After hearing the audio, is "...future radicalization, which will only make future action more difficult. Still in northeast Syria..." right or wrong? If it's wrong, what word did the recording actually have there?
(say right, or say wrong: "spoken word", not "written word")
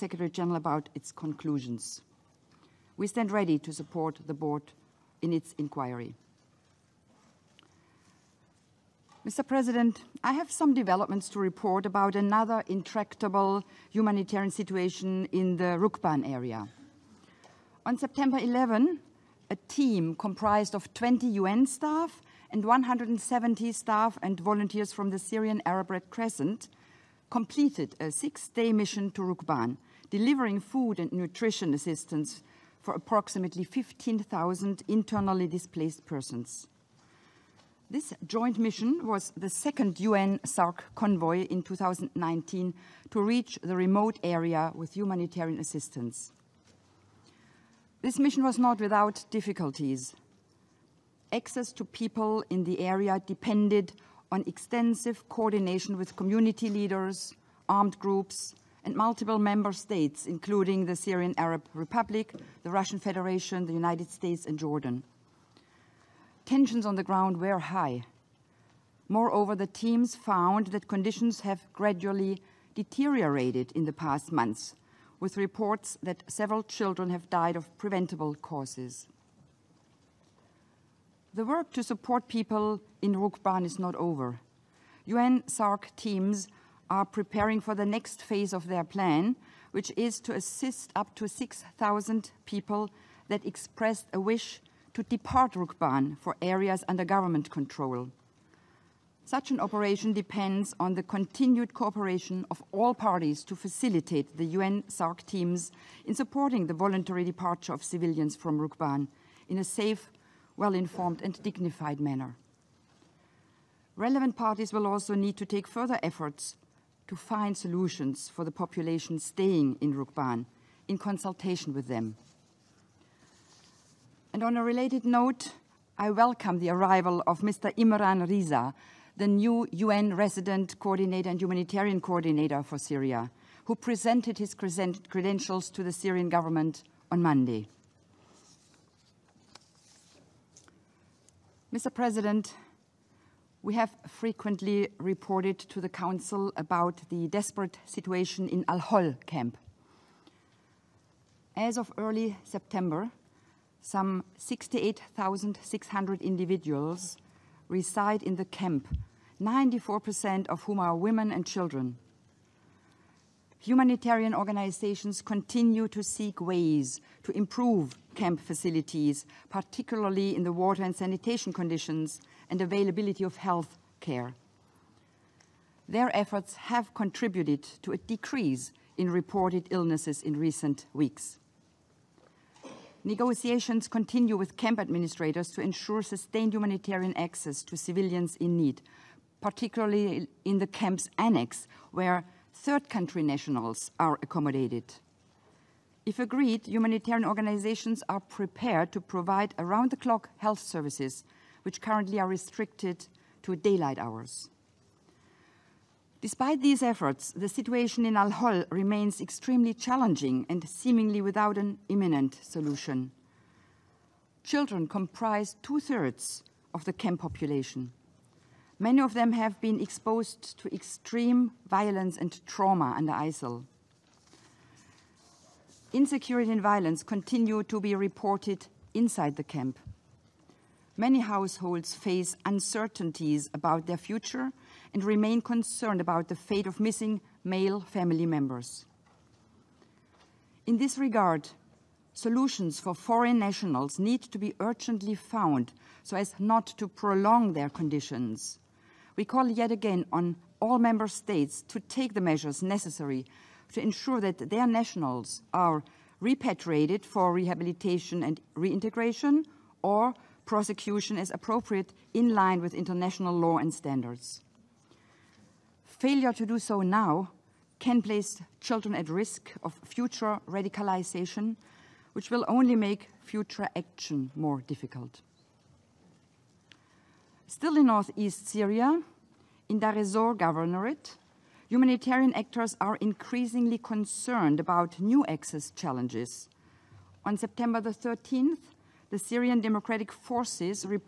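right.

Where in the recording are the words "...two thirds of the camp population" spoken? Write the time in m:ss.
3:35.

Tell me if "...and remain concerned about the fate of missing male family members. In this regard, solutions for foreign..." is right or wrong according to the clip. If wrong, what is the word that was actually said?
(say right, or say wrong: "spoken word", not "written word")
right.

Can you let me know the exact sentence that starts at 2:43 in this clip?
Humanitarian organizations continue to seek ways to improve camp facilities, particularly in the water and sanitation conditions and availability of health care.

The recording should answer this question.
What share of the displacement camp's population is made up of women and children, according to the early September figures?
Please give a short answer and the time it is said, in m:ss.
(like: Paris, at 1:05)
94%, at 2:39.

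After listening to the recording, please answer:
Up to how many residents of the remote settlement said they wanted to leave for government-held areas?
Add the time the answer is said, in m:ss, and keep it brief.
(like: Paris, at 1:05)
6,000, at 1:31.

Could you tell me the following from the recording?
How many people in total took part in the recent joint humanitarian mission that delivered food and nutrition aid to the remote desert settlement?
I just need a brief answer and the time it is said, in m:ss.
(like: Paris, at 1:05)
190, at 0:20.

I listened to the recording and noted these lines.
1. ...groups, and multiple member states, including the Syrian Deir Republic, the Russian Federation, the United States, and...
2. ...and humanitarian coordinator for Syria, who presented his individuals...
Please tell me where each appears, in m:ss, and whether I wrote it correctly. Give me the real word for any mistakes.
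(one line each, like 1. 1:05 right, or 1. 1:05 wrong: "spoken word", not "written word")
1. 0:57 wrong: "Arab", not "Deir"
2. 2:11 wrong: "credentials", not "individuals".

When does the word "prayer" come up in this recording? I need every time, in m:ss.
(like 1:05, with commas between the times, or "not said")
not said.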